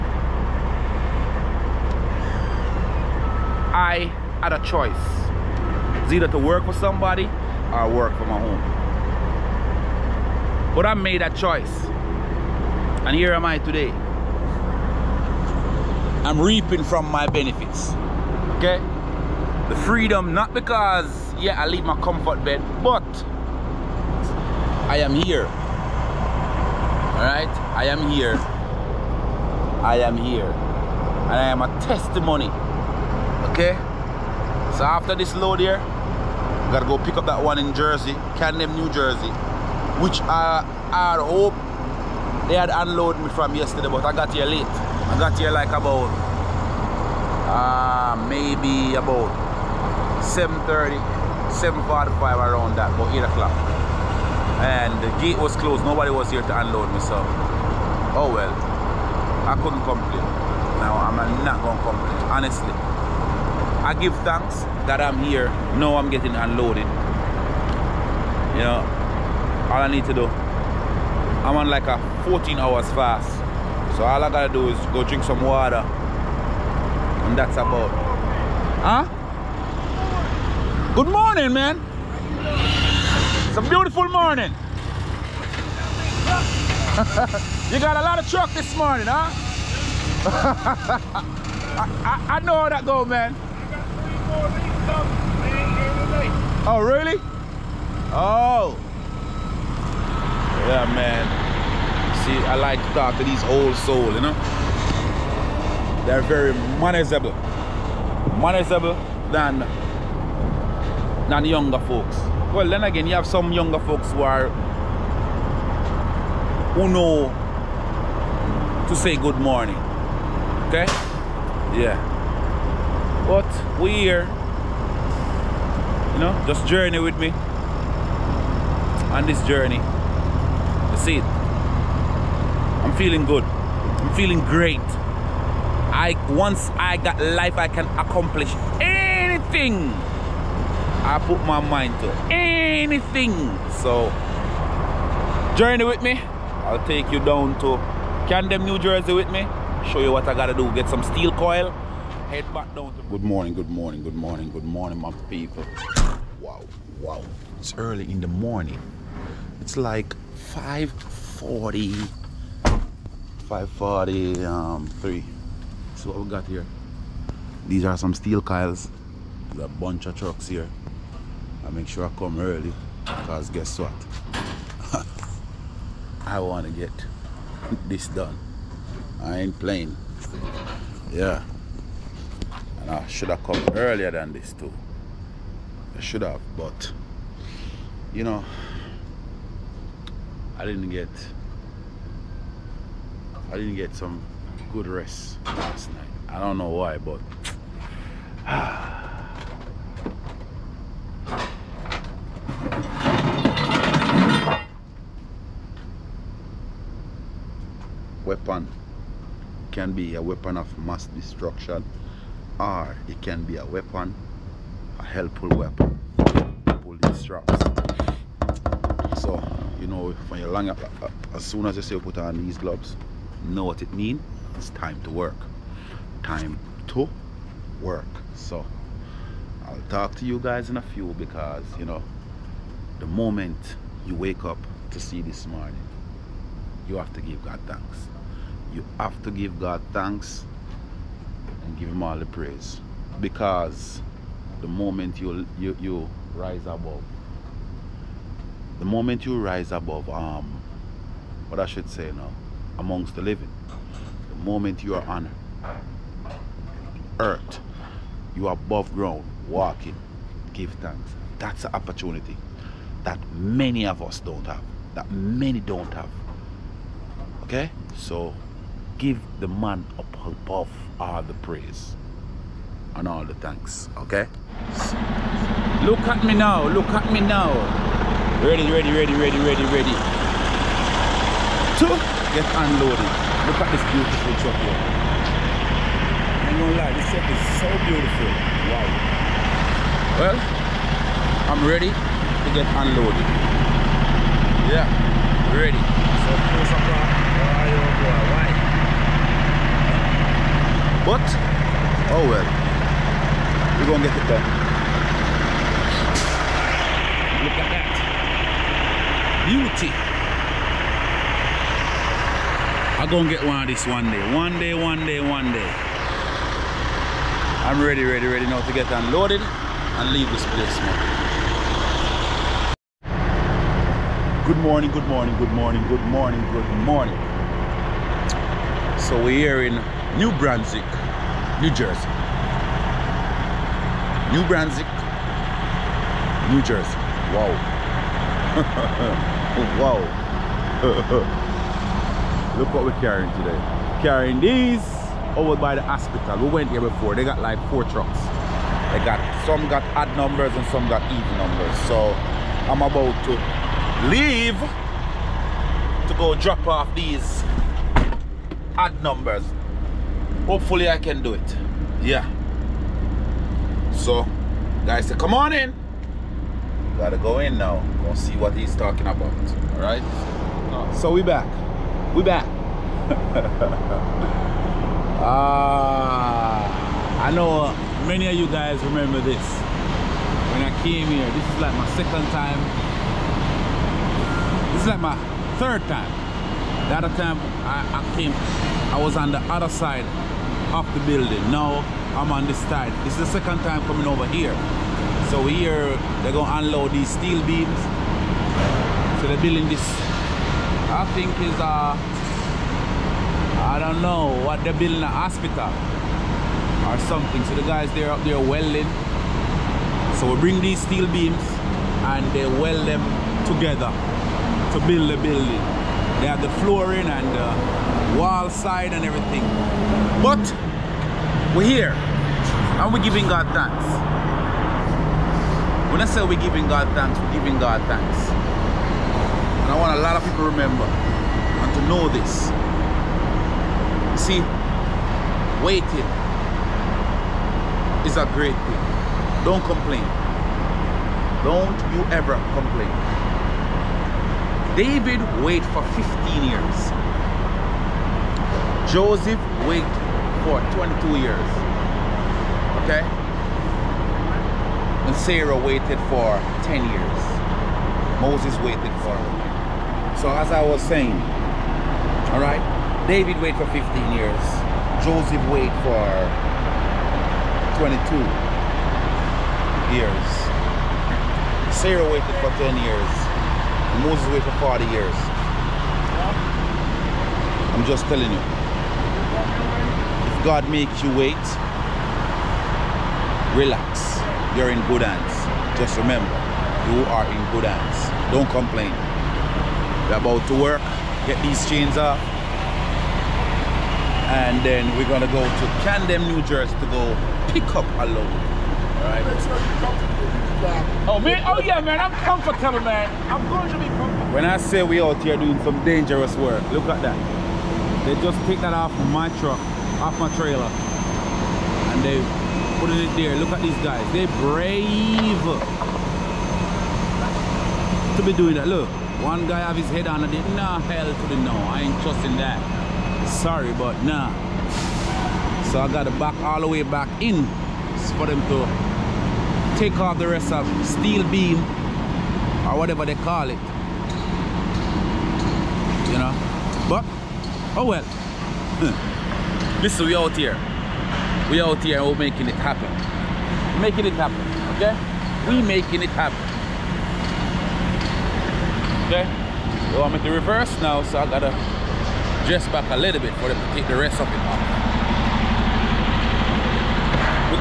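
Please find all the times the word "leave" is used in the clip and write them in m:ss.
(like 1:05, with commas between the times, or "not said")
0:21, 5:20, 5:54.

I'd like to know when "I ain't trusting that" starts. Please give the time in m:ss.
8:41.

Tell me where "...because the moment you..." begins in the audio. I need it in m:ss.
4:03.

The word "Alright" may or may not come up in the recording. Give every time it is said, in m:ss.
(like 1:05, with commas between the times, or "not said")
0:27, 8:19.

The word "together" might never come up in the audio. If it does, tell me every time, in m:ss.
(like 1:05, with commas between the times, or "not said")
6:53.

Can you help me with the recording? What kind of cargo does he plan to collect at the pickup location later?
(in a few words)
Steel coil.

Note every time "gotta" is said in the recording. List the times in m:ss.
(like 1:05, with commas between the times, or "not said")
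0:36, 1:14, 2:30, 6:06, 9:11.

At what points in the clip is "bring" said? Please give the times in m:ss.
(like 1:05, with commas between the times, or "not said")
6:50.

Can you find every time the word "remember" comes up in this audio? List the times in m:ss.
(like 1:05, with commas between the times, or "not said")
6:18, 7:10, 8:05.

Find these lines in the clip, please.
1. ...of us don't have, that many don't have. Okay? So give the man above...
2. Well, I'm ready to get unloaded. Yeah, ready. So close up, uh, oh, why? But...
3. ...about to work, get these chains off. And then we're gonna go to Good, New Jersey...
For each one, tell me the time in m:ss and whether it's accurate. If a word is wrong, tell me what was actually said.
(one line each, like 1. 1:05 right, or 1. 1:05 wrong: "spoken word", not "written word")
1. 4:23 right
2. 4:50 right
3. 8:10 wrong: "Camden", not "Good".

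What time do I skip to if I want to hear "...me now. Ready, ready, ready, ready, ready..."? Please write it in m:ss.
4:37.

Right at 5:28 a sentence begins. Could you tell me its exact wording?
So we're here in New Brunswick, New Jersey.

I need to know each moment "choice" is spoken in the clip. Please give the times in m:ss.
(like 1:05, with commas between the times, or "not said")
0:04, 0:11.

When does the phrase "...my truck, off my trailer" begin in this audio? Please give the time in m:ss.
8:29.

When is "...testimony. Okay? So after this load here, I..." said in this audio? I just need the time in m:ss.
0:31.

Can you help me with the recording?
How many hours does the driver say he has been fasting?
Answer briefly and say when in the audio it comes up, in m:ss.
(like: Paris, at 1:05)
14, at 1:12.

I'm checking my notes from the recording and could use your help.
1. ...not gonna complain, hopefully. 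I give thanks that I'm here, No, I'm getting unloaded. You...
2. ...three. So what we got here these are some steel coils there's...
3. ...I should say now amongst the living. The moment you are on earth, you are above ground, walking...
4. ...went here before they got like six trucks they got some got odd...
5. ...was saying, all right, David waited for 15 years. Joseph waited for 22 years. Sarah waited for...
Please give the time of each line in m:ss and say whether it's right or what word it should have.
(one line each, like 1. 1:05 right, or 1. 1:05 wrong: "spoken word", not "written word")
1. 1:01 wrong: "honestly", not "hopefully"
2. 2:45 right
3. 4:11 right
4. 5:46 wrong: "four", not "six"
5. 7:40 right.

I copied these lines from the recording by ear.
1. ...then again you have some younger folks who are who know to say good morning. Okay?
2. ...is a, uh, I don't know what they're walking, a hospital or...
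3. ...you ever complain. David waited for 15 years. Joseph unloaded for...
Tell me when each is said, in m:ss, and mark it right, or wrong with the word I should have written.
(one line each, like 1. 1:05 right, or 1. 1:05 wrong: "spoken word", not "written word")
1. 1:52 right
2. 6:41 wrong: "building", not "walking"
3. 7:21 wrong: "waited", not "unloaded".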